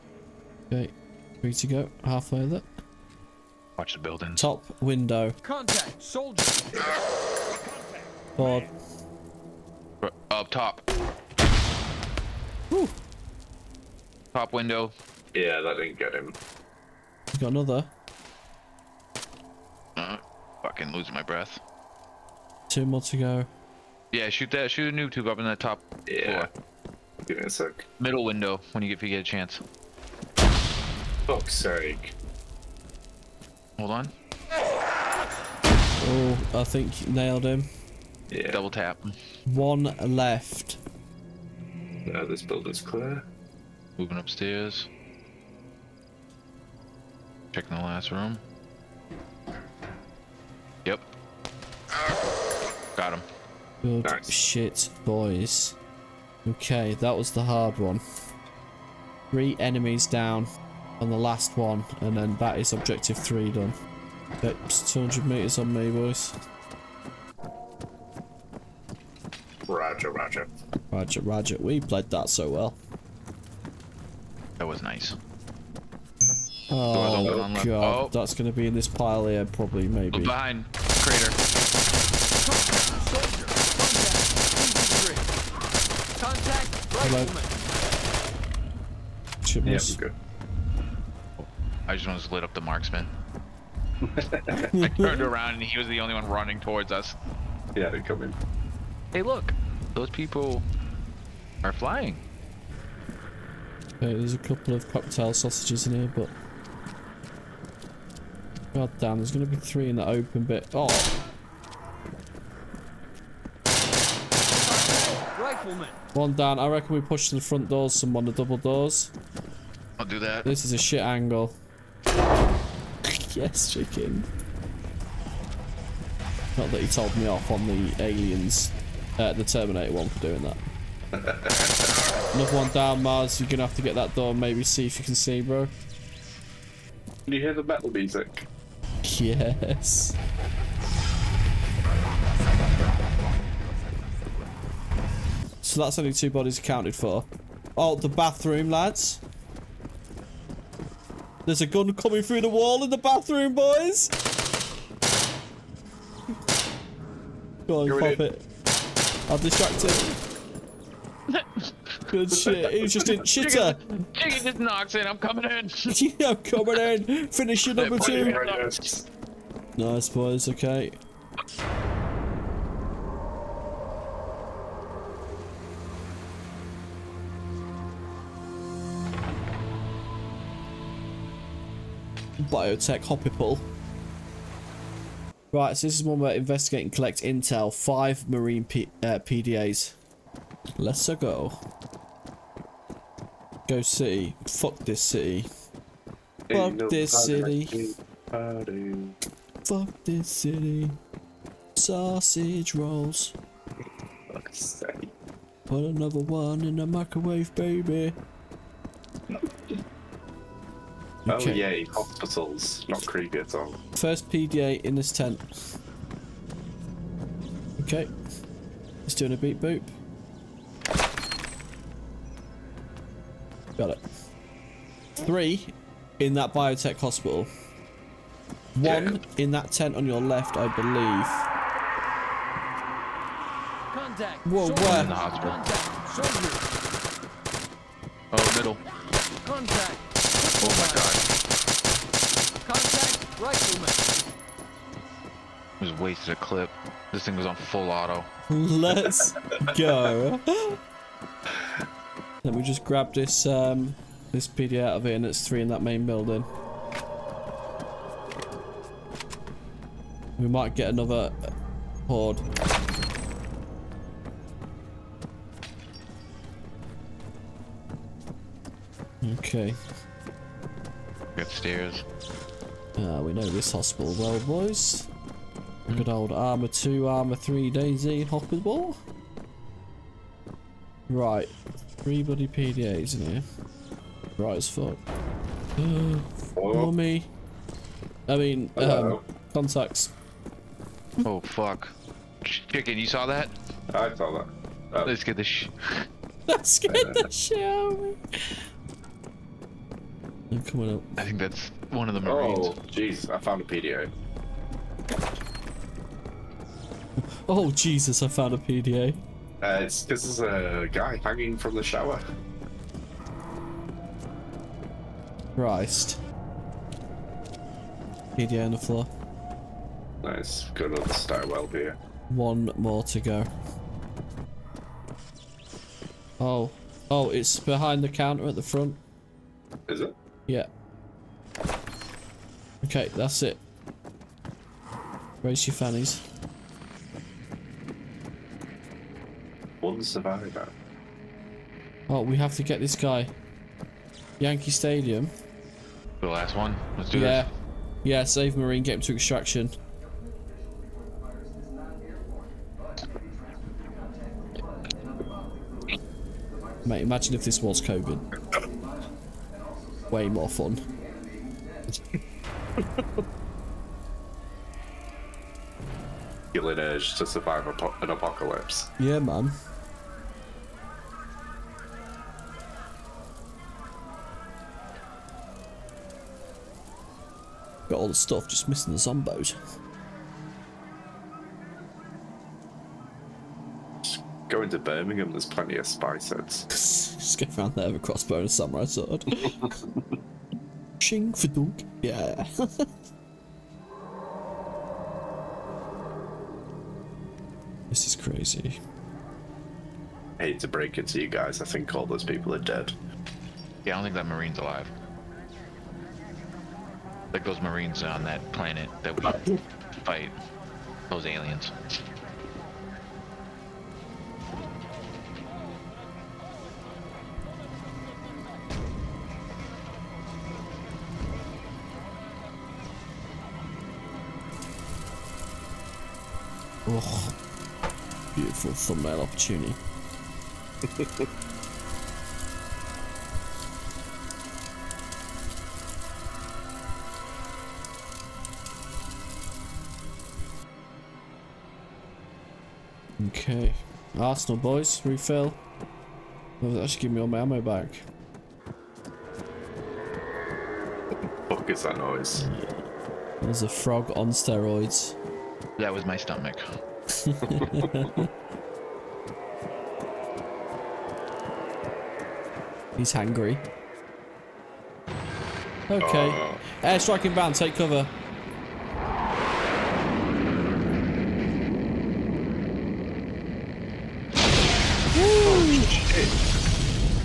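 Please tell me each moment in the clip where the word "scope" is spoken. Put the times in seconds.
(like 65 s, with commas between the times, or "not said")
not said.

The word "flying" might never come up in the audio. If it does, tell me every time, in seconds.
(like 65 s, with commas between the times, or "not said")
101 s.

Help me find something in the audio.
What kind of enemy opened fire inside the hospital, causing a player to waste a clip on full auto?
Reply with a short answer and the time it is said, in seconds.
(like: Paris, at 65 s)
Rifleman, at 242 s.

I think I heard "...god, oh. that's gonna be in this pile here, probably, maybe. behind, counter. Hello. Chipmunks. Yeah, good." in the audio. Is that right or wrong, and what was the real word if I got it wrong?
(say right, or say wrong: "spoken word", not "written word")
wrong: "crater", not "counter".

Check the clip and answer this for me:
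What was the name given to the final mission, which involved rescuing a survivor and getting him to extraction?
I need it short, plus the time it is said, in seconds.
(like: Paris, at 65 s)
Yankee Stadium, at 344 s.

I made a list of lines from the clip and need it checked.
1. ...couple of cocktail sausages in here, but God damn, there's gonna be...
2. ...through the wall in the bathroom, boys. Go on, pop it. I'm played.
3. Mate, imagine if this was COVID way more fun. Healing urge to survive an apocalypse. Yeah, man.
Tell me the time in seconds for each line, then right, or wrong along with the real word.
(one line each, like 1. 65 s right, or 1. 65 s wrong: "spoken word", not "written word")
1. 104 s right
2. 152 s wrong: "distracted", not "played"
3. 356 s right.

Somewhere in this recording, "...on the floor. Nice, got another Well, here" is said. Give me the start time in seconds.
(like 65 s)
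318 s.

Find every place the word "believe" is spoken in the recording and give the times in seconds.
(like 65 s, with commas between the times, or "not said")
230 s.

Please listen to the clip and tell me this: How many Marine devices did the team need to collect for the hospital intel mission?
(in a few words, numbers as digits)
5.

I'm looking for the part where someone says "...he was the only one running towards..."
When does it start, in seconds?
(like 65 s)
95 s.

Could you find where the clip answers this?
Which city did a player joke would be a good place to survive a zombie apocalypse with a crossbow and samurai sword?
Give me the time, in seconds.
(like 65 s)
384 s.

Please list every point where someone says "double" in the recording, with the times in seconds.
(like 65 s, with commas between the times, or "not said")
38 s, 118 s.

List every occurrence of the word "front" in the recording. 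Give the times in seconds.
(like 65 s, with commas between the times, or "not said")
117 s, 328 s.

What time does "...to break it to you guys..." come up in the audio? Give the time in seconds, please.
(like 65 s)
400 s.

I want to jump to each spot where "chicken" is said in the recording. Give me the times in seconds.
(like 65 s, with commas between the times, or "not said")
123 s, 164 s, 292 s.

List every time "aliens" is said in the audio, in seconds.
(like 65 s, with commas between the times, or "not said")
128 s, 411 s.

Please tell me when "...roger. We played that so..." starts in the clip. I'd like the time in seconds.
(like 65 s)
71 s.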